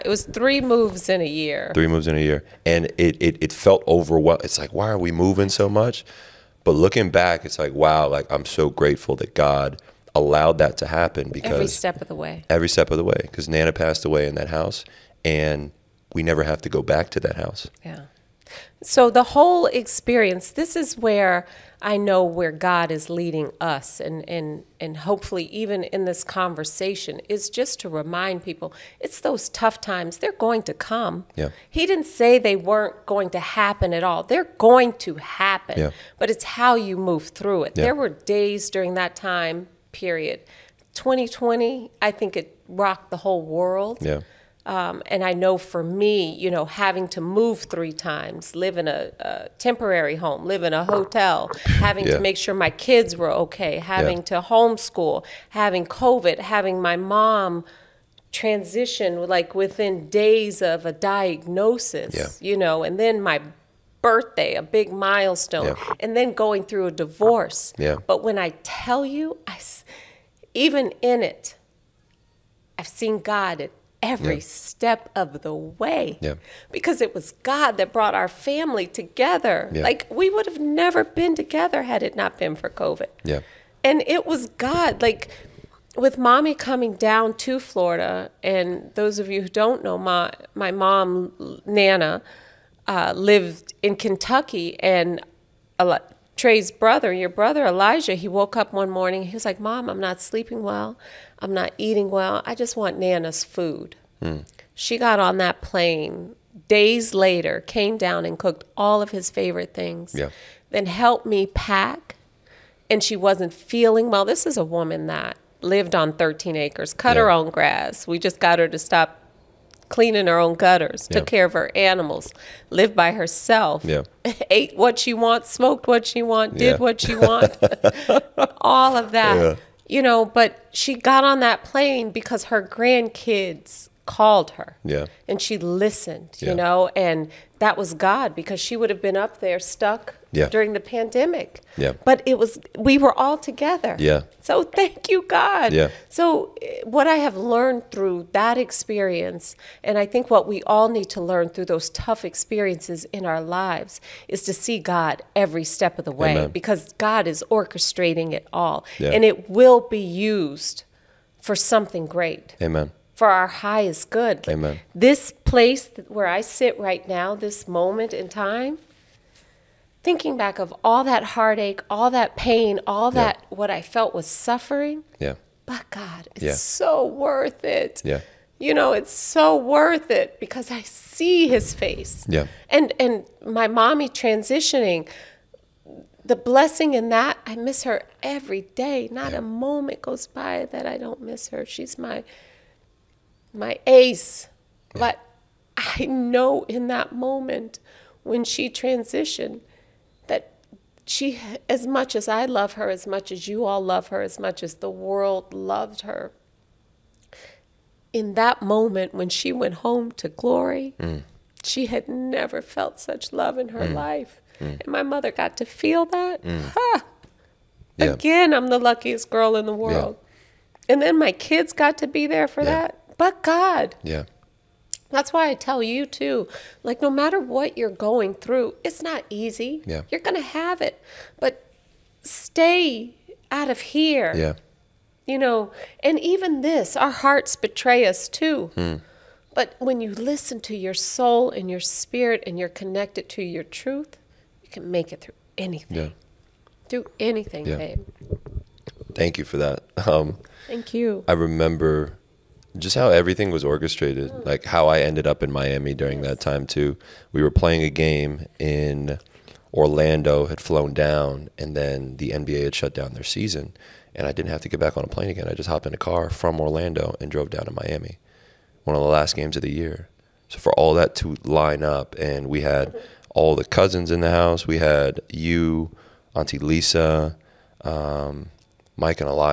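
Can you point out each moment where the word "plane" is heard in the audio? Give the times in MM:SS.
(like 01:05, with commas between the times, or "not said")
01:45, 02:11, 04:25.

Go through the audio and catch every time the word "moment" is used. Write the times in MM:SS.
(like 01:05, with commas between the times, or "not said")
02:47, 03:09, 03:17, 03:28.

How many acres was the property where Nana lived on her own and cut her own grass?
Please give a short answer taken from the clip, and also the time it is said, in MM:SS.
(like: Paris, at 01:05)
13, at 01:56.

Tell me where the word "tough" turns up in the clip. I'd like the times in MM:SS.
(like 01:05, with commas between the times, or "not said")
00:29, 02:31.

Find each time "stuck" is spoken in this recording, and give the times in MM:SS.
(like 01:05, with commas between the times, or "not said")
02:19.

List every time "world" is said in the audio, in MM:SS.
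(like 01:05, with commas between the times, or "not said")
00:43, 03:24, 03:39.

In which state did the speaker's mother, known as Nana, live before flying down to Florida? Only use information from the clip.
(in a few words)
Kentucky.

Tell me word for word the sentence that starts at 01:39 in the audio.
He was like, "Mom, I'm not sleeping well.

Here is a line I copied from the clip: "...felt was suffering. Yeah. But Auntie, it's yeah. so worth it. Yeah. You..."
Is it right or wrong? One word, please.
wrong.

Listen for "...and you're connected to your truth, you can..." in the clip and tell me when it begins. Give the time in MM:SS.
04:02.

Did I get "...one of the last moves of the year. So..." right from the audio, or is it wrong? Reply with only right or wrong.
wrong.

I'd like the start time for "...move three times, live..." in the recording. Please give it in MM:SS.
00:47.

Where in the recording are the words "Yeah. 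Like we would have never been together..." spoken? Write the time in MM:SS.
01:19.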